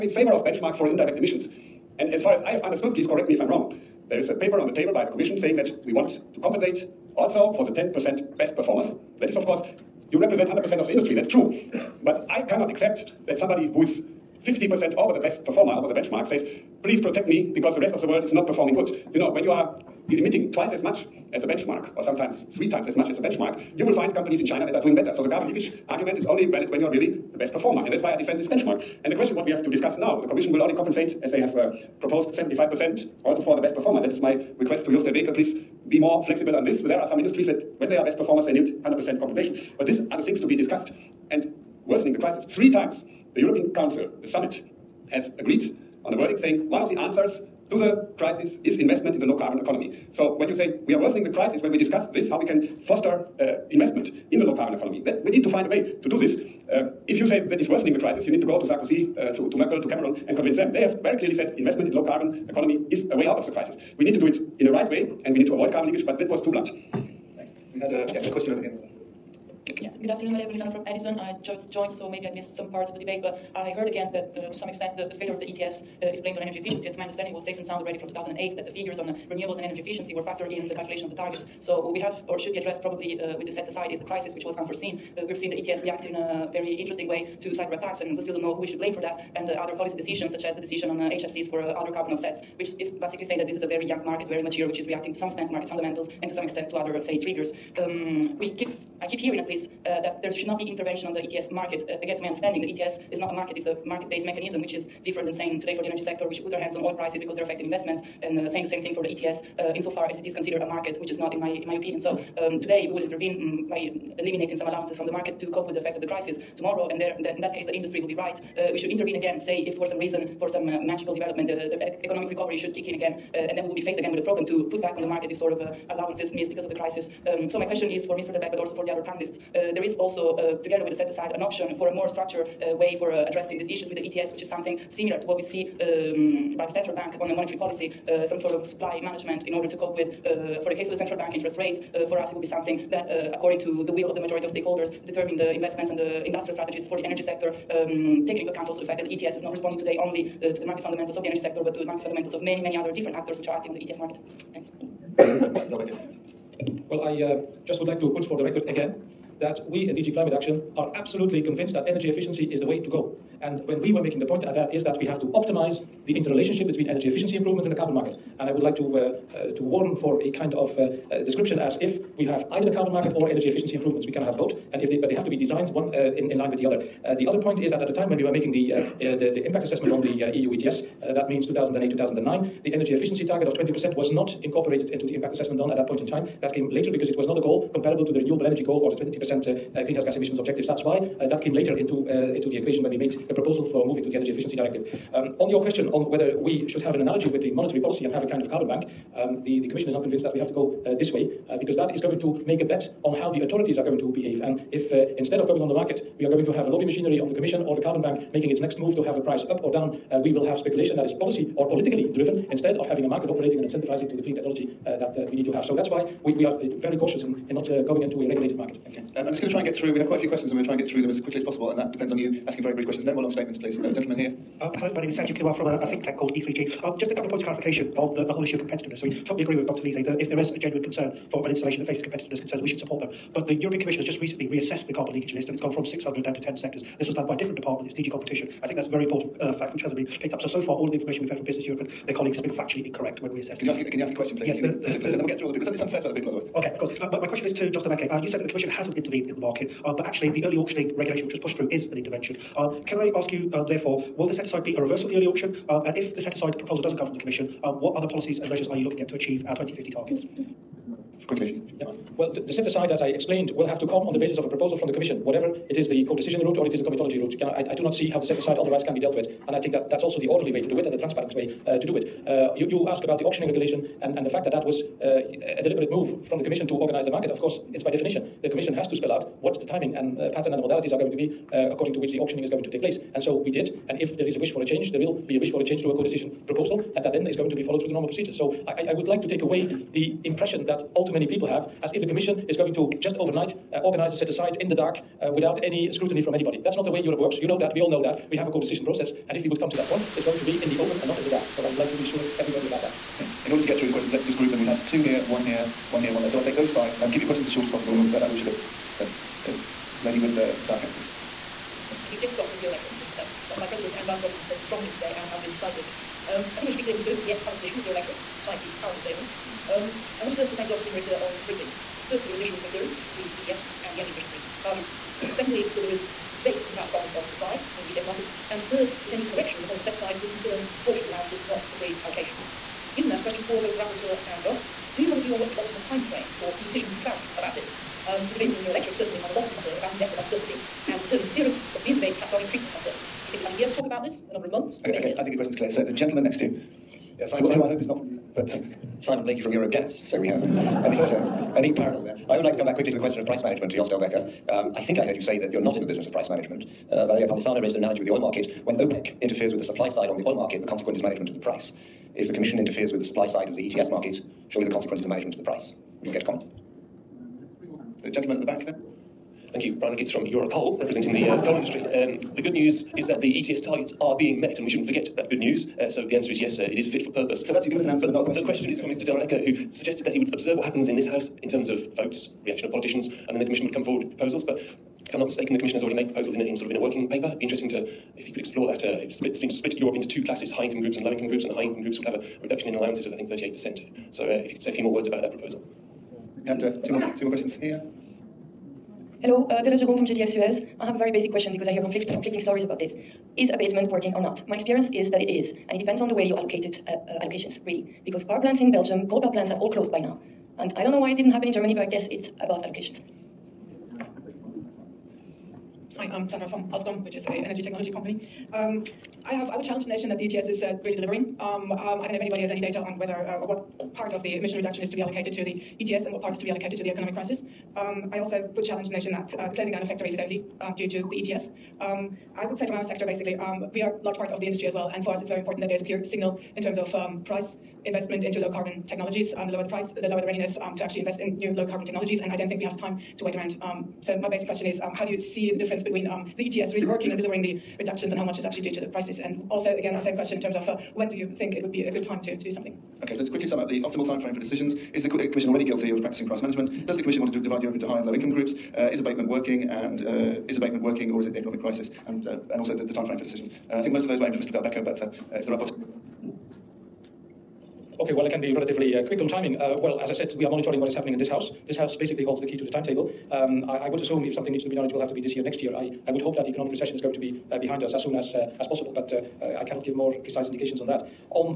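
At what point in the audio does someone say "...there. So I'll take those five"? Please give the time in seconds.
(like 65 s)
306 s.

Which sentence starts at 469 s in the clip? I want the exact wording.
Uh, well, as I said, we are monitoring what is happening in this house.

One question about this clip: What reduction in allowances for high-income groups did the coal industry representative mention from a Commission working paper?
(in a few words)
38 percent.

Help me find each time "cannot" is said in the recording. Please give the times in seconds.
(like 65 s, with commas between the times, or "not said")
12 s, 479 s.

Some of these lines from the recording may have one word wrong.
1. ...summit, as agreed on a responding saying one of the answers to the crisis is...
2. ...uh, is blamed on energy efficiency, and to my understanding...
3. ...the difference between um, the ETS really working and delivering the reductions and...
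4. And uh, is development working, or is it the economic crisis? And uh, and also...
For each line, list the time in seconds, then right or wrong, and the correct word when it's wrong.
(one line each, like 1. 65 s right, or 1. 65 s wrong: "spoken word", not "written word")
1. 44 s wrong: "wording", not "responding"
2. 76 s right
3. 445 s right
4. 459 s wrong: "abatement", not "development".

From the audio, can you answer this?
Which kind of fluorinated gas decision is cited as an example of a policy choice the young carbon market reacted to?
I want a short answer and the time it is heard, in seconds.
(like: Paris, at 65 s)
HFCs, at 90 s.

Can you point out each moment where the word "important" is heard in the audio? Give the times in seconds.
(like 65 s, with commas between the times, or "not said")
239 s, 435 s.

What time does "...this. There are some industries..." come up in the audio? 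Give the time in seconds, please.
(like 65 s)
36 s.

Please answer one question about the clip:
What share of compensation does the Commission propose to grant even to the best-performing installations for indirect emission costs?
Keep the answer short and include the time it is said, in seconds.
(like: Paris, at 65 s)
75%, at 32 s.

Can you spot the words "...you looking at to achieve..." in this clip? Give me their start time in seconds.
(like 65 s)
258 s.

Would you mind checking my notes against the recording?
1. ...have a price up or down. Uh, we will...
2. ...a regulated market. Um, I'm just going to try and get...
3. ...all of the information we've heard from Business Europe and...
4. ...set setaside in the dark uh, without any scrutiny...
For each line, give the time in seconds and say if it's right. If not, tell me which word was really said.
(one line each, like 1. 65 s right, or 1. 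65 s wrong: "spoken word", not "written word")
1. 209 s right
2. 218 s right
3. 240 s right
4. 294 s wrong: "aside", not "setaside".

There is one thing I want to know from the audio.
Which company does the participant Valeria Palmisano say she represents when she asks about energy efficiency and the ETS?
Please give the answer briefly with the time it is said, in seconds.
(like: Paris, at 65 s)
Edison, at 70 s.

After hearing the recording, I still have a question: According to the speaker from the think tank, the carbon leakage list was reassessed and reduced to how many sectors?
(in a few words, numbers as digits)
10.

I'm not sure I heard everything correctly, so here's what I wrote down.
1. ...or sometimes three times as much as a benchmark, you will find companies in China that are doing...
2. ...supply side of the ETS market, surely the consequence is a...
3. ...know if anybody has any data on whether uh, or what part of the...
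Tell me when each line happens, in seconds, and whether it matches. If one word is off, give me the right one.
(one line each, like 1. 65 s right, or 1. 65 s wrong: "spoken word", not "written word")
1. 21 s right
2. 363 s right
3. 422 s right.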